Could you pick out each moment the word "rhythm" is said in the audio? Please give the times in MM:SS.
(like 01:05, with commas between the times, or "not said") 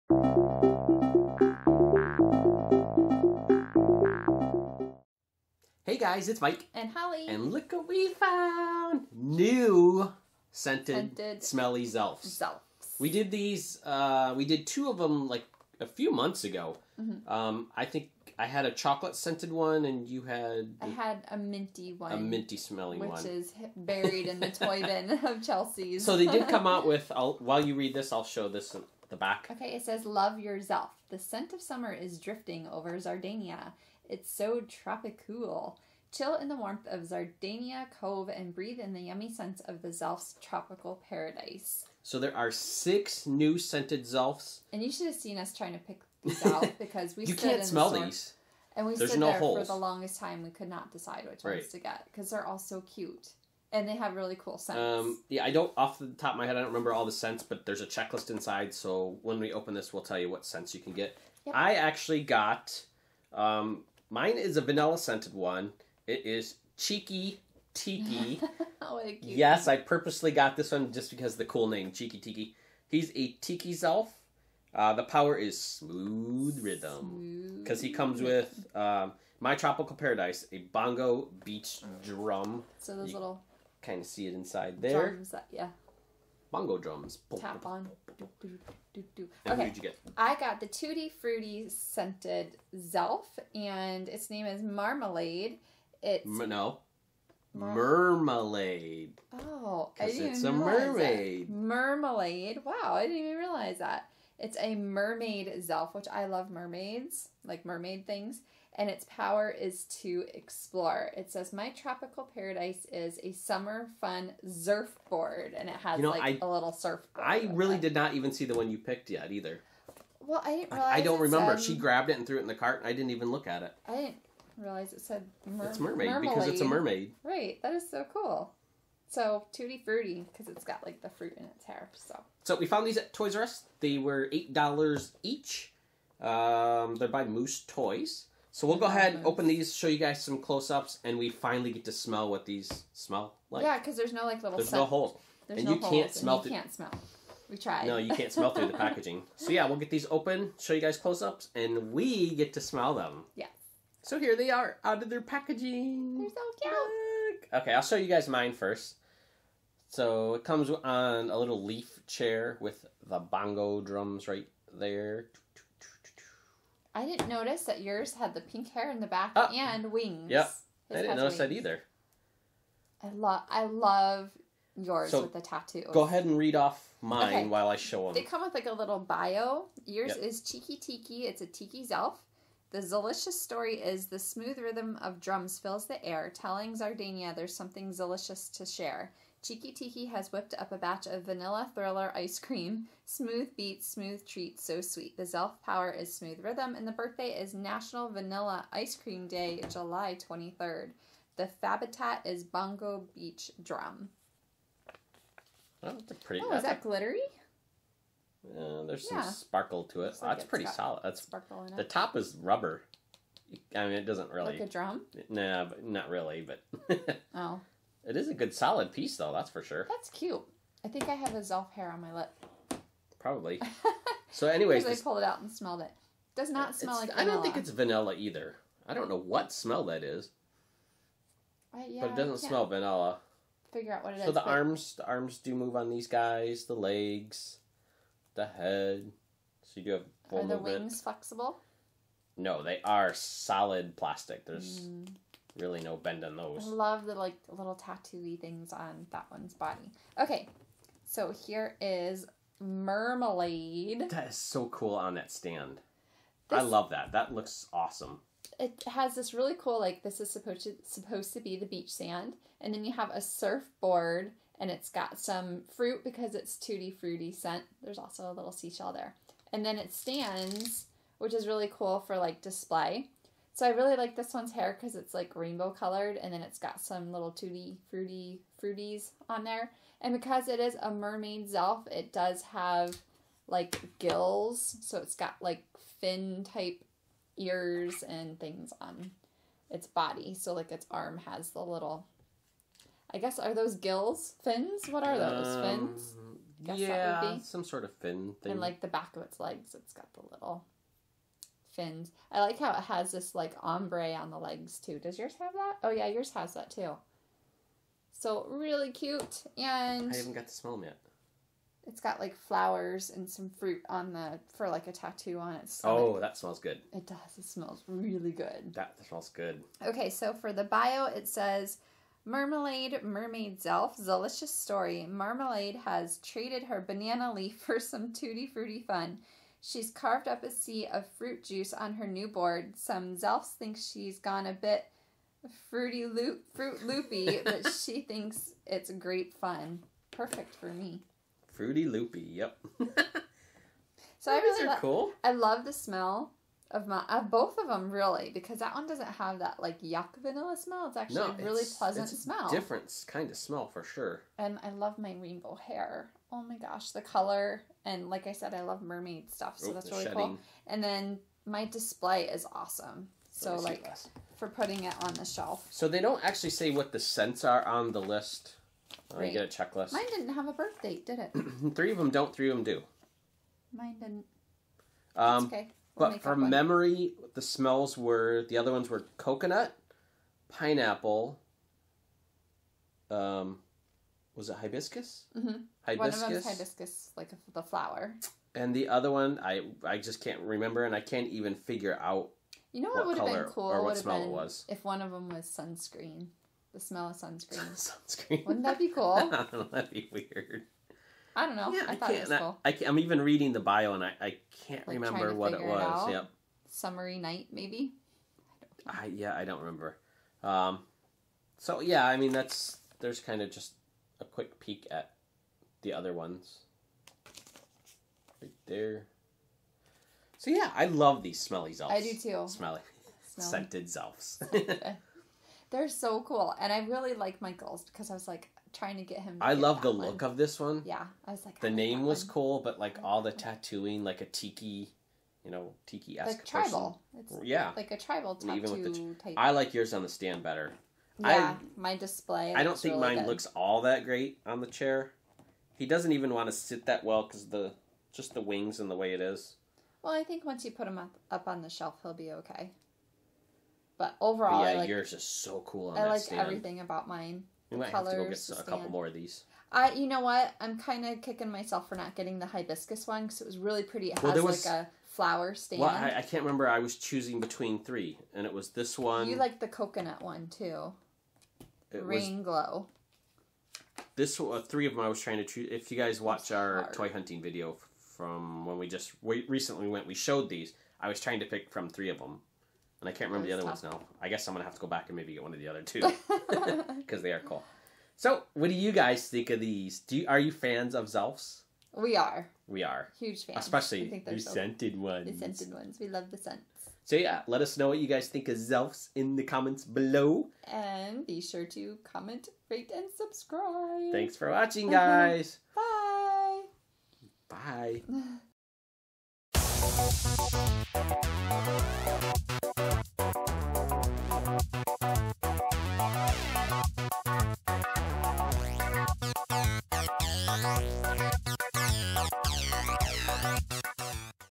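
01:16, 03:04, 03:16.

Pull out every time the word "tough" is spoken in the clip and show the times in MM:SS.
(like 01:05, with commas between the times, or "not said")
08:03.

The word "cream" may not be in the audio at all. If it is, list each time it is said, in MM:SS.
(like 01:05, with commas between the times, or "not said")
03:12, 03:18.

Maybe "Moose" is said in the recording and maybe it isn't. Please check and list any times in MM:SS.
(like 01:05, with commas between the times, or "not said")
02:17.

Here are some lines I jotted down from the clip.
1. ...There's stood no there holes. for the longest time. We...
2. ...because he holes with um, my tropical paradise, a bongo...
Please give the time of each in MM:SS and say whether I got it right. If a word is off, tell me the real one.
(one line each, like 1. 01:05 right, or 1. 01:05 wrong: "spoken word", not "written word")
1. 00:48 right
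2. 01:17 wrong: "comes", not "holes".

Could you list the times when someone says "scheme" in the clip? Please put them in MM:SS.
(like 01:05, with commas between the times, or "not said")
not said.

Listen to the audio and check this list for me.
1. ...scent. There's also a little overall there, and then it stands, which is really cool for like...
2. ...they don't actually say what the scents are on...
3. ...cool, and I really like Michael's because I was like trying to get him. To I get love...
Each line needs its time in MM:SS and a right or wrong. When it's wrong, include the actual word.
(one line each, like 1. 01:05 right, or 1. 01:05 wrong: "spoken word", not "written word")
1. 04:27 wrong: "seashell", not "overall"
2. 06:05 right
3. 07:06 right.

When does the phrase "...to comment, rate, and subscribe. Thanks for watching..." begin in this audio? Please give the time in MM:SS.
08:21.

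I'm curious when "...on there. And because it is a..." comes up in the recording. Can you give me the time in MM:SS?
04:39.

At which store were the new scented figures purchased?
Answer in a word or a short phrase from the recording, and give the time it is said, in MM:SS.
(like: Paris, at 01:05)
Toys R Us, at 02:13.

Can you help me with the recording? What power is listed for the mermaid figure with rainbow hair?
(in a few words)
Explore.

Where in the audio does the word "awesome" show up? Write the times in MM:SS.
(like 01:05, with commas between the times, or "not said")
04:17, 06:02.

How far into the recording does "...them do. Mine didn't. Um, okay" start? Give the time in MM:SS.
06:12.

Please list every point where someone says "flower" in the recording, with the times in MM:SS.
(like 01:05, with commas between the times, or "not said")
05:12, 06:27, 07:45.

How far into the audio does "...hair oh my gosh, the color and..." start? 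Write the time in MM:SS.
05:55.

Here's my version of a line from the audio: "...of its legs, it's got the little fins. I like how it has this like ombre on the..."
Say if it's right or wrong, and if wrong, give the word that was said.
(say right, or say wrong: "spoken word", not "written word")
right.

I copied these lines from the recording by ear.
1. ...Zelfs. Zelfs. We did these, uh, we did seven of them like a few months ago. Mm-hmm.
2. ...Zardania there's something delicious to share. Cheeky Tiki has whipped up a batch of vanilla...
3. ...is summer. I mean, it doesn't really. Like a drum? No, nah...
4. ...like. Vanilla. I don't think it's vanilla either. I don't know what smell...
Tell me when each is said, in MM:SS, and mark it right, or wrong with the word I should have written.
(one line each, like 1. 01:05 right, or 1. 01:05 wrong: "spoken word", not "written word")
1. 00:11 wrong: "two", not "seven"
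2. 03:06 right
3. 03:32 wrong: "rubber", not "summer"
4. 03:46 right.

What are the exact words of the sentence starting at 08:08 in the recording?
So, what do you guys think of these?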